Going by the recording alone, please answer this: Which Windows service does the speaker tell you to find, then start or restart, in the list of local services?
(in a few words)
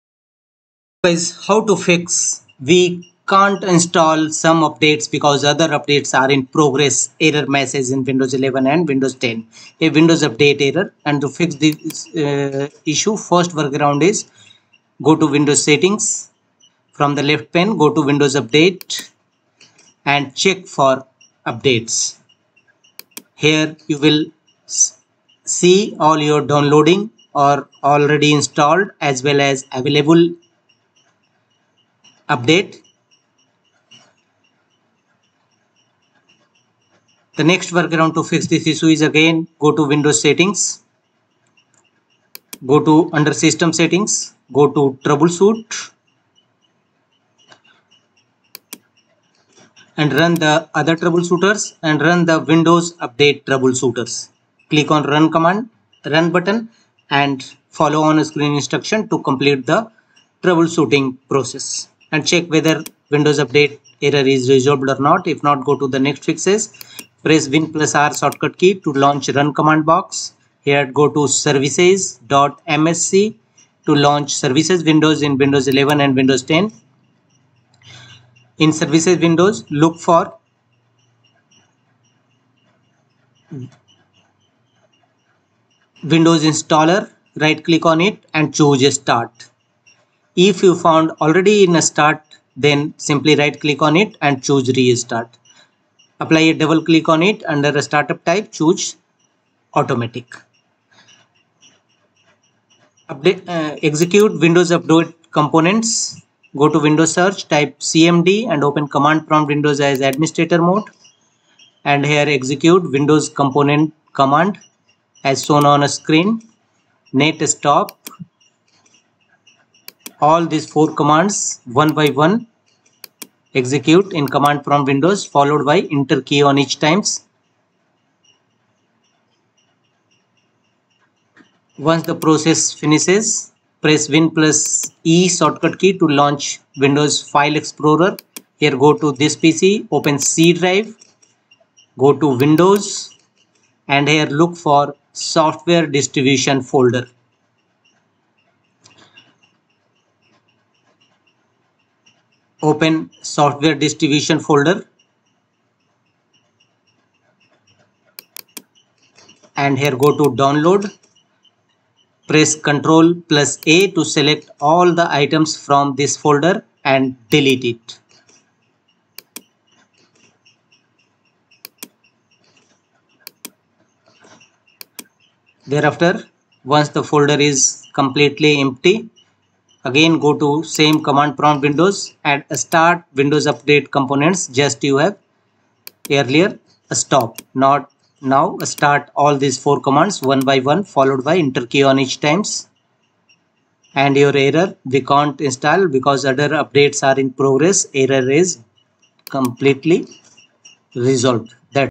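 Windows Installer.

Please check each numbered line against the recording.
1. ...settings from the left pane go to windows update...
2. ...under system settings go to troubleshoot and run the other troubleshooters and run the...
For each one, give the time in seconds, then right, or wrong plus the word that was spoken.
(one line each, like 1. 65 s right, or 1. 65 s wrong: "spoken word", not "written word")
1. 15 s right
2. 43 s right.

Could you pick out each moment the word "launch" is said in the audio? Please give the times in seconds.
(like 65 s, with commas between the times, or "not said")
68 s, 73 s, 136 s.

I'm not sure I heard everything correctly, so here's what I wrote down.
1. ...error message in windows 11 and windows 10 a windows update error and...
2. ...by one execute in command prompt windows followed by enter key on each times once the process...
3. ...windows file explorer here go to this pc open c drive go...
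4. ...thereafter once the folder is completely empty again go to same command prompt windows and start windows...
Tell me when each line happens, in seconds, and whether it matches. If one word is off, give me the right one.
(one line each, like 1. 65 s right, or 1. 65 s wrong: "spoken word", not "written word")
1. 7 s right
2. 121 s right
3. 136 s right
4. 175 s right.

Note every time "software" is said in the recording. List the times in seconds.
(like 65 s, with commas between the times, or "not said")
145 s, 153 s.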